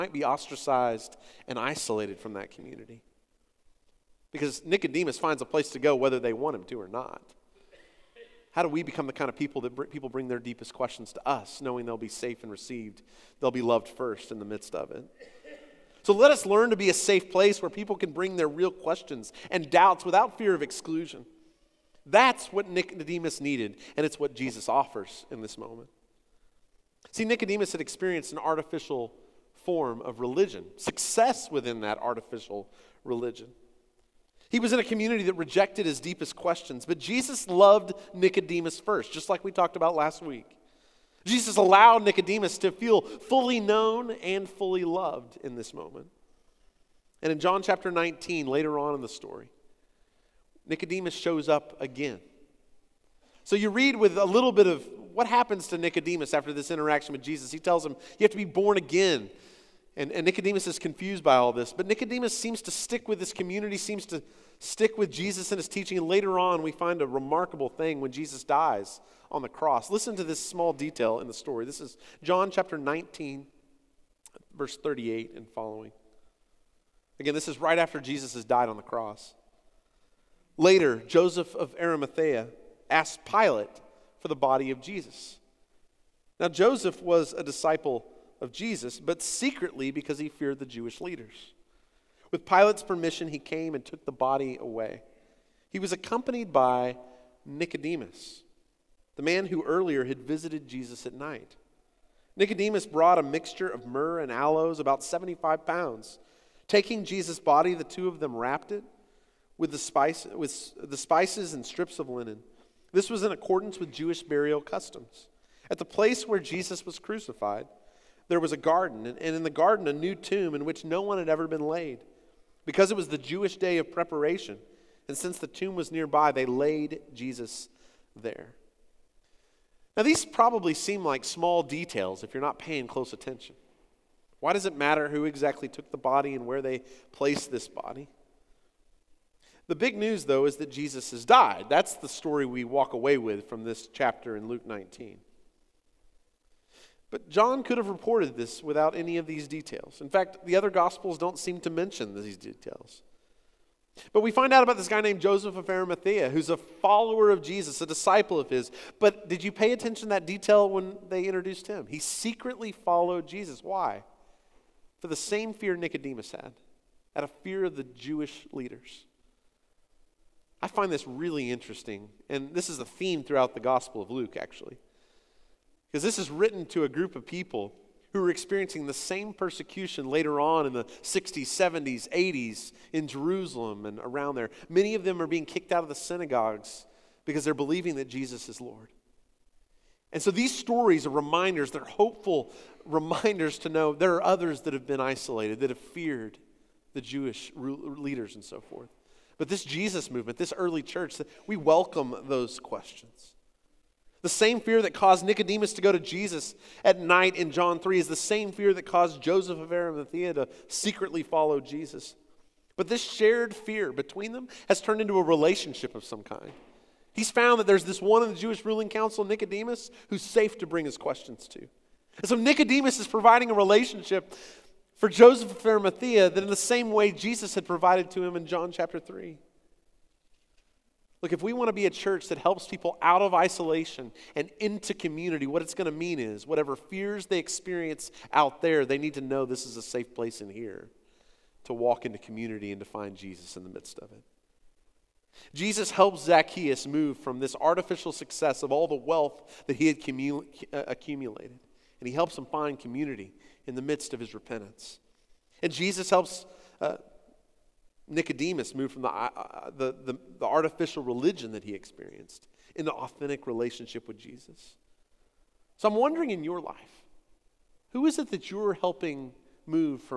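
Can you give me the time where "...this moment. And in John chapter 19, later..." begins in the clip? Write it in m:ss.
0:45.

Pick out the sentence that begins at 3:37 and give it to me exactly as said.
He's found that there's this one in the Jewish ruling council, Nicodemus, who's safe to bring his questions to.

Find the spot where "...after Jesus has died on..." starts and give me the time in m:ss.
1:17.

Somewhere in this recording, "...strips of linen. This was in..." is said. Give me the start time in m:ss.
1:51.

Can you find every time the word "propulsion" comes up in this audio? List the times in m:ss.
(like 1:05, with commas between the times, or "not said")
not said.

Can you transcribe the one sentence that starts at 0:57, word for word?
He tells him, You have to be born again.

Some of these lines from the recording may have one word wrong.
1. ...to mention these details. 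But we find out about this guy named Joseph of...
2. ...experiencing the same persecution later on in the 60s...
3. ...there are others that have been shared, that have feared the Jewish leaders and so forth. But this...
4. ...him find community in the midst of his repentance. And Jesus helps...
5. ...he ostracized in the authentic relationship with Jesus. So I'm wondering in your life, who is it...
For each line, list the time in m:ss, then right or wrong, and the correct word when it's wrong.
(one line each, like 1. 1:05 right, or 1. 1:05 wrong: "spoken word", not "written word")
1. 2:31 right
2. 2:58 right
3. 3:13 wrong: "isolated", not "shared"
4. 4:12 right
5. 4:21 wrong: "experienced", not "ostracized".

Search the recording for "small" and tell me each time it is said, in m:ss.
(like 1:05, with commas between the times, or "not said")
1:10, 2:11.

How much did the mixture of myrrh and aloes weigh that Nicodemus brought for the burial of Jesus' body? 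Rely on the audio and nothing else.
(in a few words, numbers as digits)
75 pounds.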